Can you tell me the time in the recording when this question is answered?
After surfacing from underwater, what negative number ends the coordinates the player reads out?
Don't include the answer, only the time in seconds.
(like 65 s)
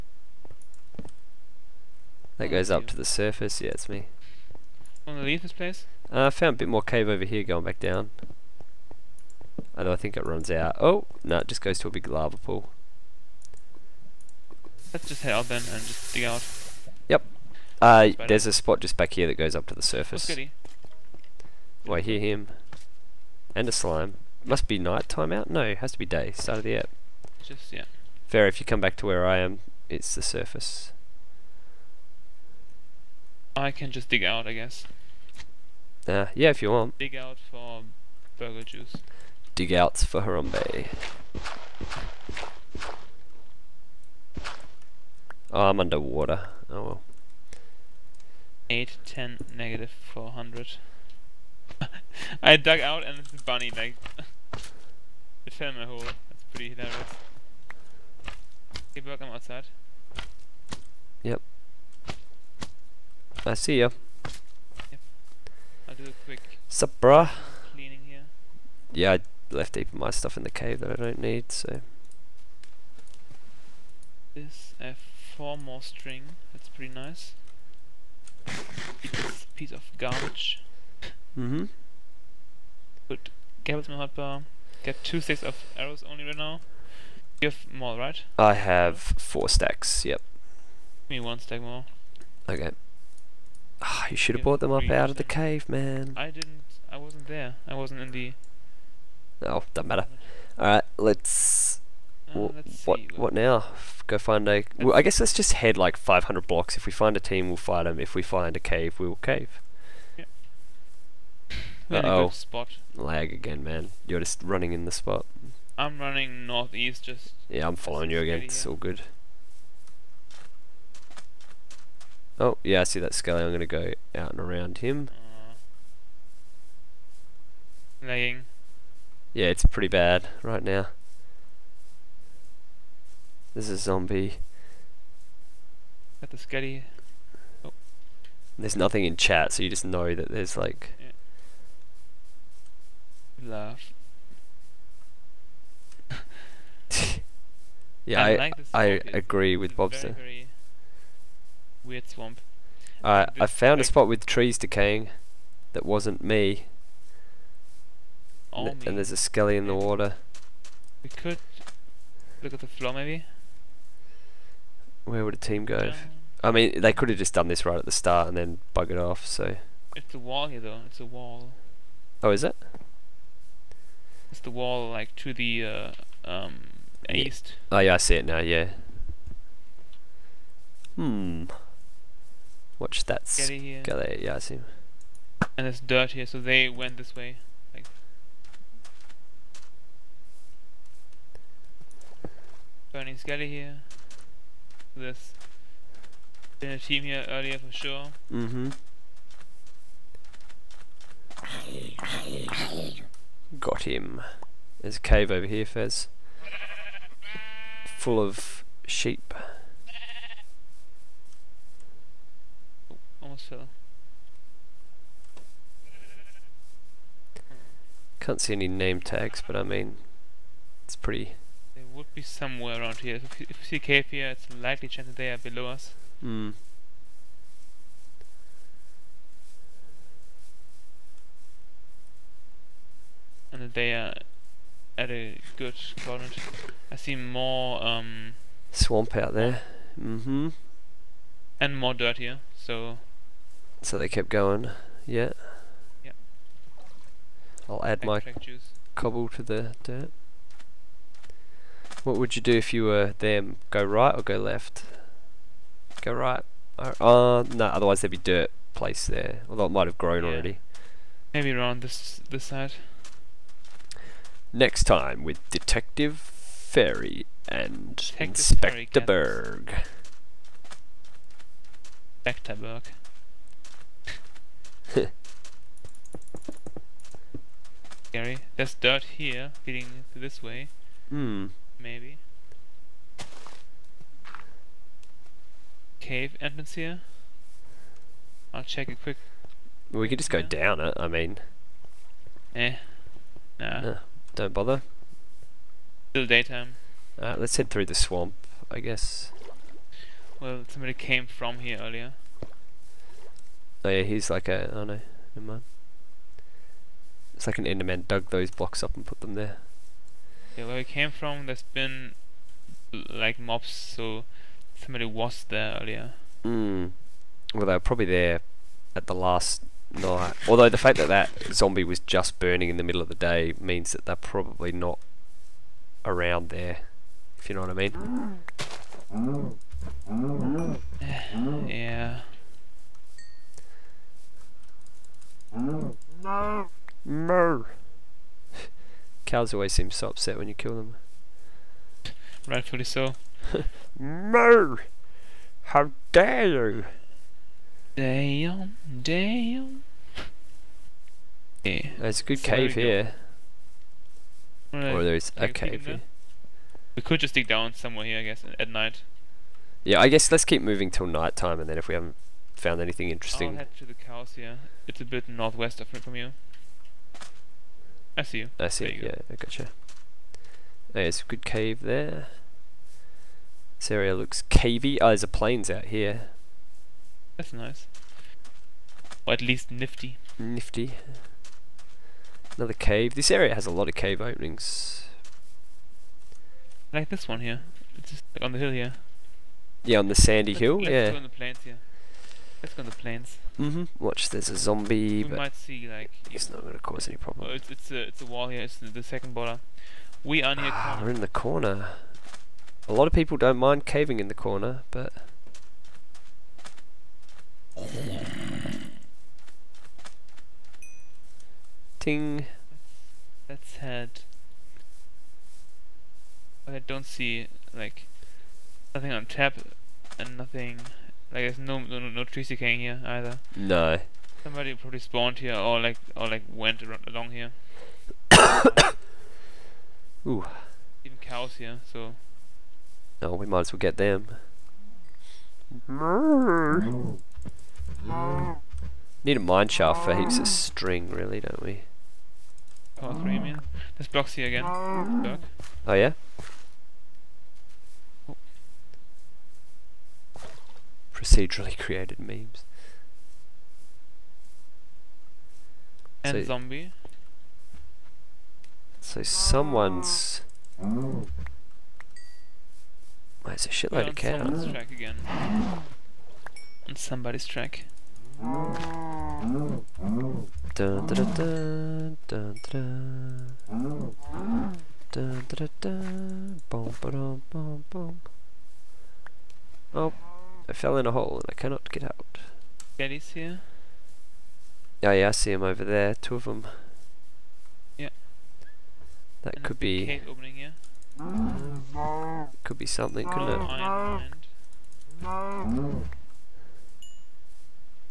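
49 s.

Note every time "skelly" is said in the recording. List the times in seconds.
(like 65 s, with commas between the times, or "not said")
123 s, 159 s, 183 s, 193 s.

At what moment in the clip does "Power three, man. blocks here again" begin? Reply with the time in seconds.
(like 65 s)
442 s.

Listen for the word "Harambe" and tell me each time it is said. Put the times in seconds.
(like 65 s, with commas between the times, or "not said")
40 s.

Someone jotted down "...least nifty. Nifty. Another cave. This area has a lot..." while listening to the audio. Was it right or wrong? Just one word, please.
right.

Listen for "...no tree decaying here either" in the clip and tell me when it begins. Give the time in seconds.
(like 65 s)
421 s.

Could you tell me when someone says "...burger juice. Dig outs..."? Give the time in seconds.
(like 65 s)
38 s.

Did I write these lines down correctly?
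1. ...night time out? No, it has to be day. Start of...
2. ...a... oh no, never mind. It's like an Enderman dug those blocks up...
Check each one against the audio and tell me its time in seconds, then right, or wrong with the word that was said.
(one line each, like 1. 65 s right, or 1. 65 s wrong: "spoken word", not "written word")
1. 24 s right
2. 304 s right.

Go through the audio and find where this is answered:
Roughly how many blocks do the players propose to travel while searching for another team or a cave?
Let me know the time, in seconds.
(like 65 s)
105 s.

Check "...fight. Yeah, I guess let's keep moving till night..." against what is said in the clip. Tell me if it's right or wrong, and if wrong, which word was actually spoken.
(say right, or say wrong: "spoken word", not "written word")
wrong: "night", not "fight".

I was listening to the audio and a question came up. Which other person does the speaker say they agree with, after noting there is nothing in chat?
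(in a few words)
Bobster.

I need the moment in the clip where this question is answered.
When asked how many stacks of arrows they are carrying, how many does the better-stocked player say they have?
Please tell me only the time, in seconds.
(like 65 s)
88 s.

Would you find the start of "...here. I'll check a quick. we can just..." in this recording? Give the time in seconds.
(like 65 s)
286 s.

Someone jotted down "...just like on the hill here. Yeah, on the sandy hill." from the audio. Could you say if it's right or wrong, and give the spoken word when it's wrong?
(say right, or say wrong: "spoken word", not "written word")
right.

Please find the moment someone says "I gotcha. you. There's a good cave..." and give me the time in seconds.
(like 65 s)
369 s.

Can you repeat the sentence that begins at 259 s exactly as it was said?
Although it might have grown yeah.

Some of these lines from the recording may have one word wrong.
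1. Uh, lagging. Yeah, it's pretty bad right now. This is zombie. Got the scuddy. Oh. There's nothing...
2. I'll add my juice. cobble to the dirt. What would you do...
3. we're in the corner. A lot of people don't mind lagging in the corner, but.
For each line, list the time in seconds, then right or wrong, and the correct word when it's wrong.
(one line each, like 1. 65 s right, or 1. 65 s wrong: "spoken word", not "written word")
1. 128 s right
2. 247 s right
3. 401 s wrong: "caving", not "lagging".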